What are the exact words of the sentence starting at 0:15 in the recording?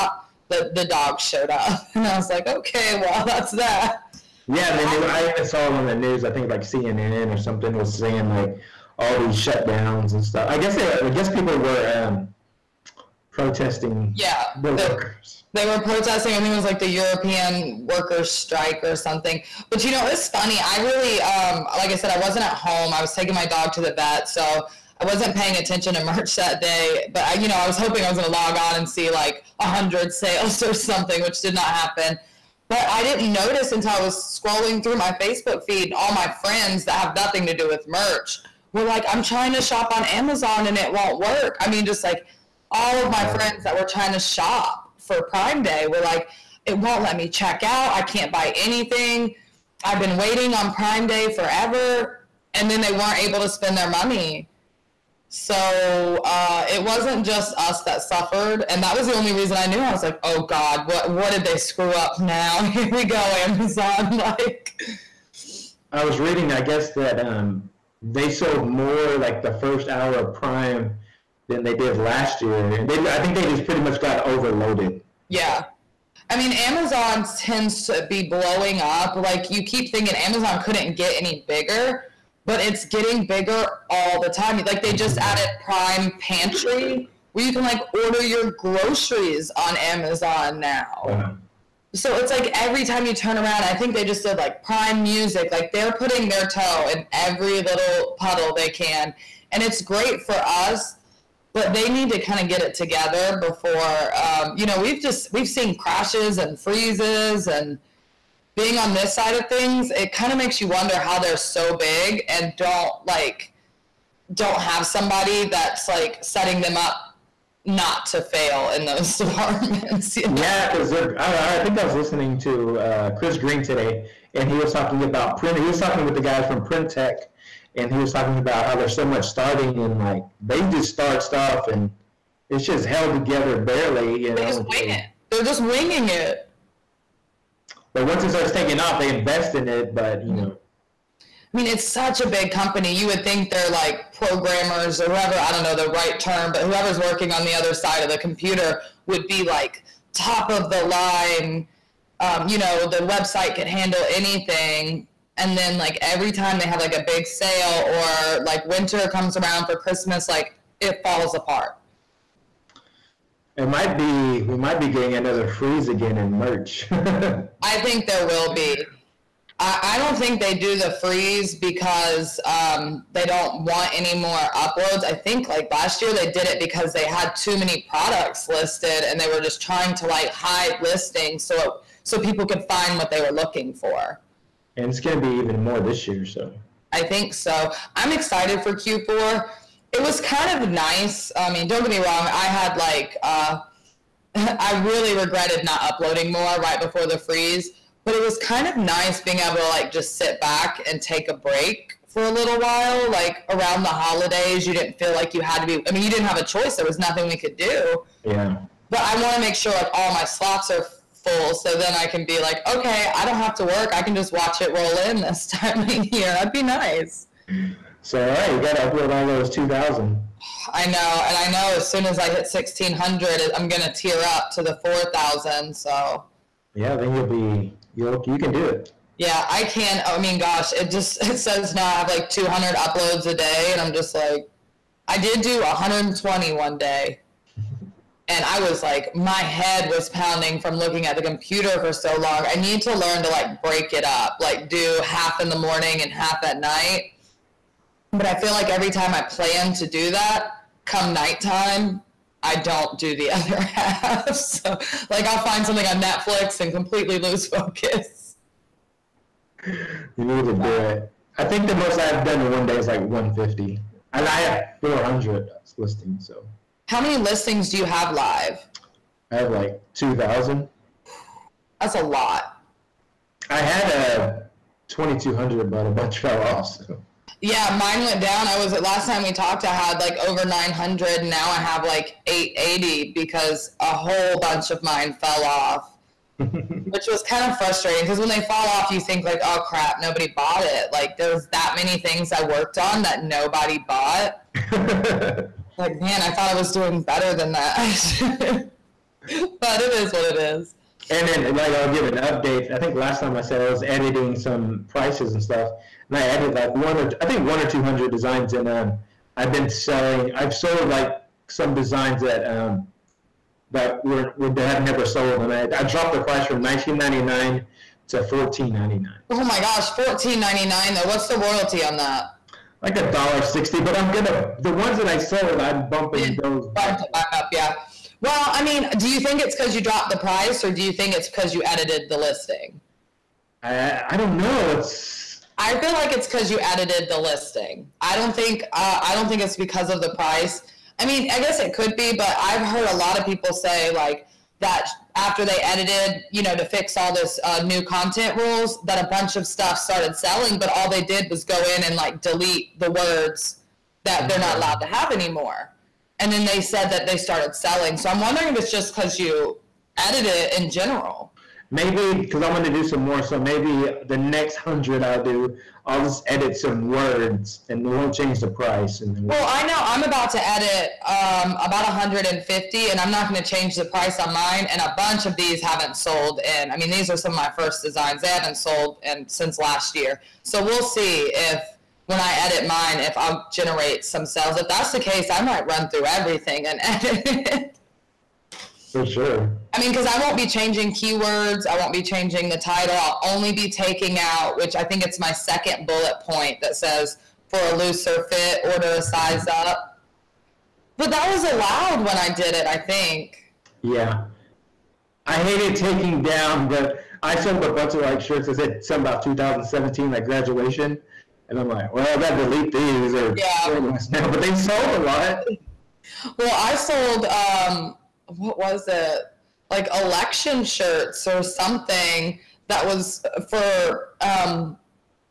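They were protesting, I think it was like the European workers strike or something.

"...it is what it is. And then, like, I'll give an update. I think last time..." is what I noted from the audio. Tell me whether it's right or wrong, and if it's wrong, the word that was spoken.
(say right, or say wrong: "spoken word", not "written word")
right.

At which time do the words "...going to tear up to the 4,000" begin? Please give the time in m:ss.
3:43.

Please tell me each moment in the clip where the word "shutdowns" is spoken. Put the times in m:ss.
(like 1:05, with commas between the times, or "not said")
0:09.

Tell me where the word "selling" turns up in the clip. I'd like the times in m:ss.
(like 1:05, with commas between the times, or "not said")
5:09, 5:50, 5:57.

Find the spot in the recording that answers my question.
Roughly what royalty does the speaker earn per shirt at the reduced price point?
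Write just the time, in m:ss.
5:22.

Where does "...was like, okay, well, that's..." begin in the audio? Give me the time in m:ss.
0:02.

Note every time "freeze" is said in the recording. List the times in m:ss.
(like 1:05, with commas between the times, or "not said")
1:46, 2:45, 2:50, 3:17.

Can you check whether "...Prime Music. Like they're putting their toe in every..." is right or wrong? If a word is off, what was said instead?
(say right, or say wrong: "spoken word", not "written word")
right.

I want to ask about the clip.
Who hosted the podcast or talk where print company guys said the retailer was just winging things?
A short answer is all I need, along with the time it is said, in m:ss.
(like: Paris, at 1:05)
Chris Green, at 2:03.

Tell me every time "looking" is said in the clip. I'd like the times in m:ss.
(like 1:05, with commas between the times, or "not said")
3:03, 4:00.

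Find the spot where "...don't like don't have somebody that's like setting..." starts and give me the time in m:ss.
1:52.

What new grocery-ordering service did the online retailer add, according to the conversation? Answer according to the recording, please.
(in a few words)
Prime Pantry.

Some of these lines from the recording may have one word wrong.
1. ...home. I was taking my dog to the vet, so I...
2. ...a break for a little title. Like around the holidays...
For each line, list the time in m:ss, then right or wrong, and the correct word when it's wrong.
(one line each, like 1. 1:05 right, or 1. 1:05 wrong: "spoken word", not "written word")
1. 0:22 right
2. 3:21 wrong: "while", not "title".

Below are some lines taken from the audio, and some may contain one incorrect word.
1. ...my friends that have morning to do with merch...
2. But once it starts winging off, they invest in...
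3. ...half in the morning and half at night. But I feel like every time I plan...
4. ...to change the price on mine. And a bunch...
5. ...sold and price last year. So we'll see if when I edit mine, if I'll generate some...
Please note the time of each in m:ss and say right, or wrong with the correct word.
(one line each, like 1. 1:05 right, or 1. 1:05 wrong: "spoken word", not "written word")
1. 0:36 wrong: "nothing", not "morning"
2. 2:17 wrong: "taking", not "winging"
3. 4:05 right
4. 6:13 right
5. 6:18 wrong: "since", not "price".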